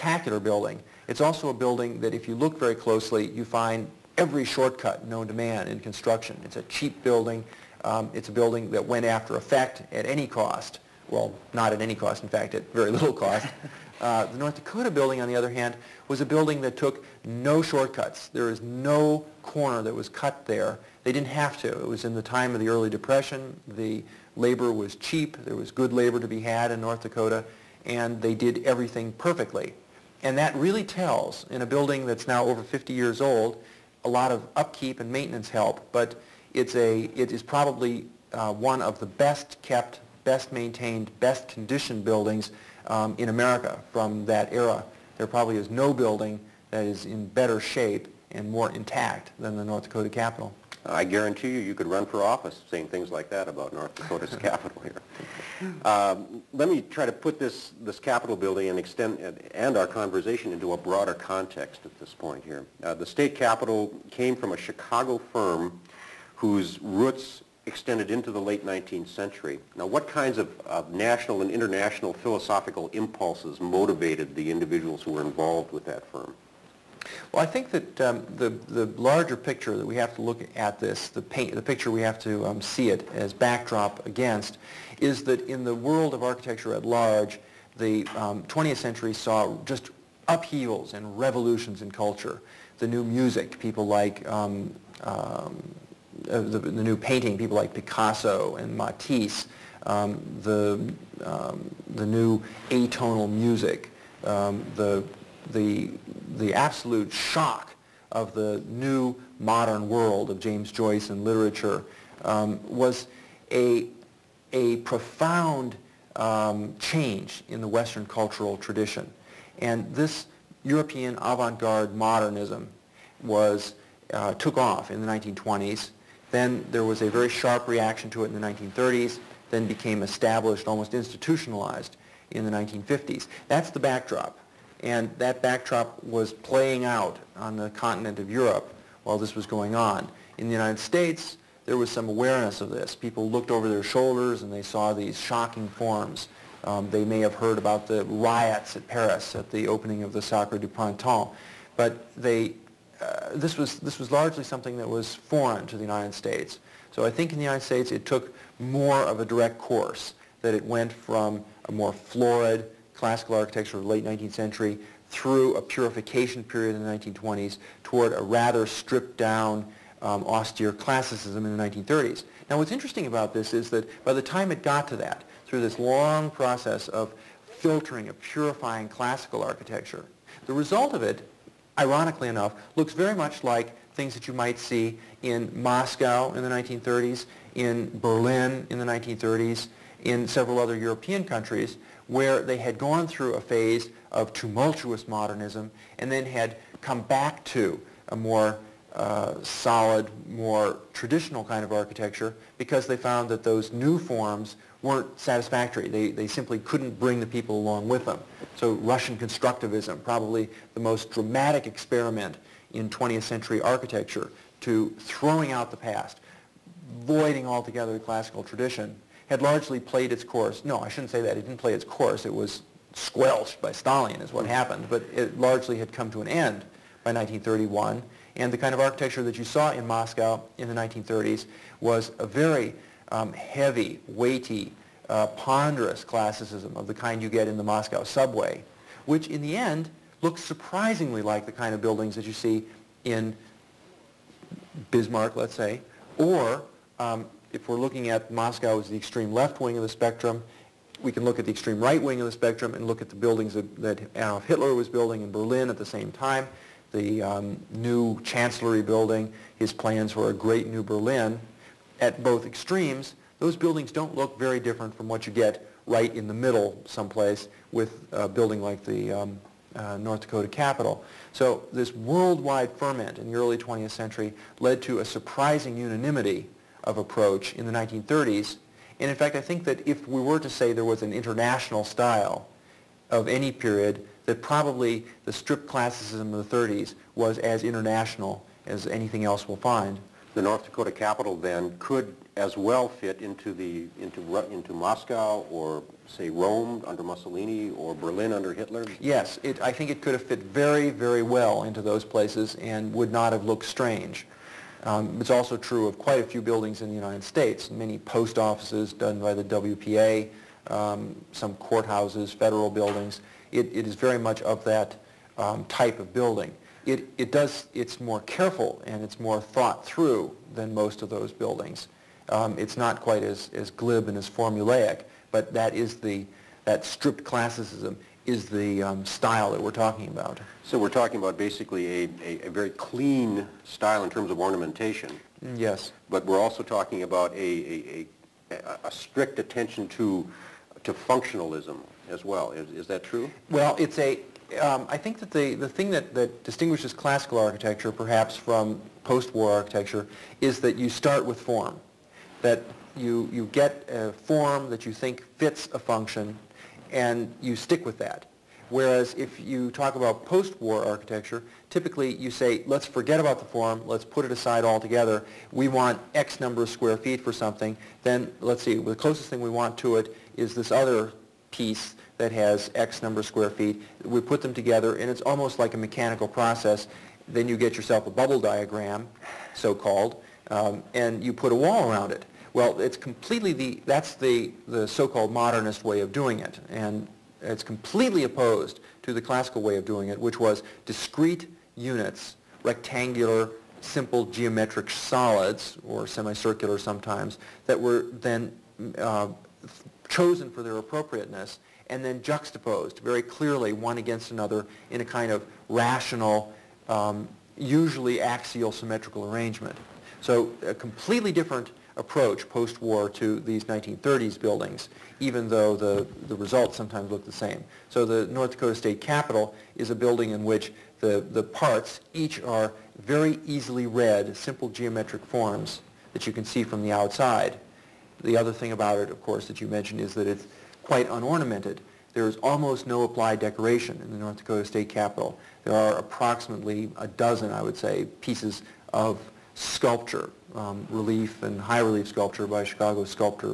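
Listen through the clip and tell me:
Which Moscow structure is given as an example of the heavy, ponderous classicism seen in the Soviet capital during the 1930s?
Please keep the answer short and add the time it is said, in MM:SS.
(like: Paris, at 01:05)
Moscow subway, at 03:57.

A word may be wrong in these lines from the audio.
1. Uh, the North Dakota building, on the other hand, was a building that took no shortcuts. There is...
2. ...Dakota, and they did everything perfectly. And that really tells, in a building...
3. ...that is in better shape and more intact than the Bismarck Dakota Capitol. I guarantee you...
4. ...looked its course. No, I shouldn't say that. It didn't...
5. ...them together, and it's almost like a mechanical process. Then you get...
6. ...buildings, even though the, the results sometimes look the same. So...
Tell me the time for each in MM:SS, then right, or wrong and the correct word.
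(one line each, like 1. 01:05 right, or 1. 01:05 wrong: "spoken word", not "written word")
1. 00:14 right
2. 00:27 right
3. 00:46 wrong: "North", not "Bismarck"
4. 03:39 wrong: "played", not "looked"
5. 06:14 right
6. 06:54 right.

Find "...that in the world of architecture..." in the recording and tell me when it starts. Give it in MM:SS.
01:25.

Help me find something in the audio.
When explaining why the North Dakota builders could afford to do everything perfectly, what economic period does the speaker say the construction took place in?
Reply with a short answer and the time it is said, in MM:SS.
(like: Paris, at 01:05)
Early depression, at 00:22.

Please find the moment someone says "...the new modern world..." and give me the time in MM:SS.
01:48.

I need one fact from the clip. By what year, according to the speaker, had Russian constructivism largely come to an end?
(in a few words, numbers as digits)
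1931.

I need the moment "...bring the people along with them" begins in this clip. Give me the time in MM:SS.
03:26.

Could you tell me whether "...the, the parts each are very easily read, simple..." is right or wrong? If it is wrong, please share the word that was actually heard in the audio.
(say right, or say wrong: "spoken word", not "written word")
right.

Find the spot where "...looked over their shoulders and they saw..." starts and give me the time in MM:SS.
02:23.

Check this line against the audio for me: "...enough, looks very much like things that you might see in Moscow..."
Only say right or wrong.
right.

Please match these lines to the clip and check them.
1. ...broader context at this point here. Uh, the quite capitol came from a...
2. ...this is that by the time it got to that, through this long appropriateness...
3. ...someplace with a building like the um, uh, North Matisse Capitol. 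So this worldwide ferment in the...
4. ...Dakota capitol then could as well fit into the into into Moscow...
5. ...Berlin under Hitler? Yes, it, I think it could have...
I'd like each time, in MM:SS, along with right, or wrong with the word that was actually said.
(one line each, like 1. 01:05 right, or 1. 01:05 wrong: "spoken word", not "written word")
1. 01:00 wrong: "state", not "quite"
2. 02:53 wrong: "process", not "appropriateness"
3. 04:26 wrong: "Dakota", not "Matisse"
4. 04:50 right
5. 04:57 right.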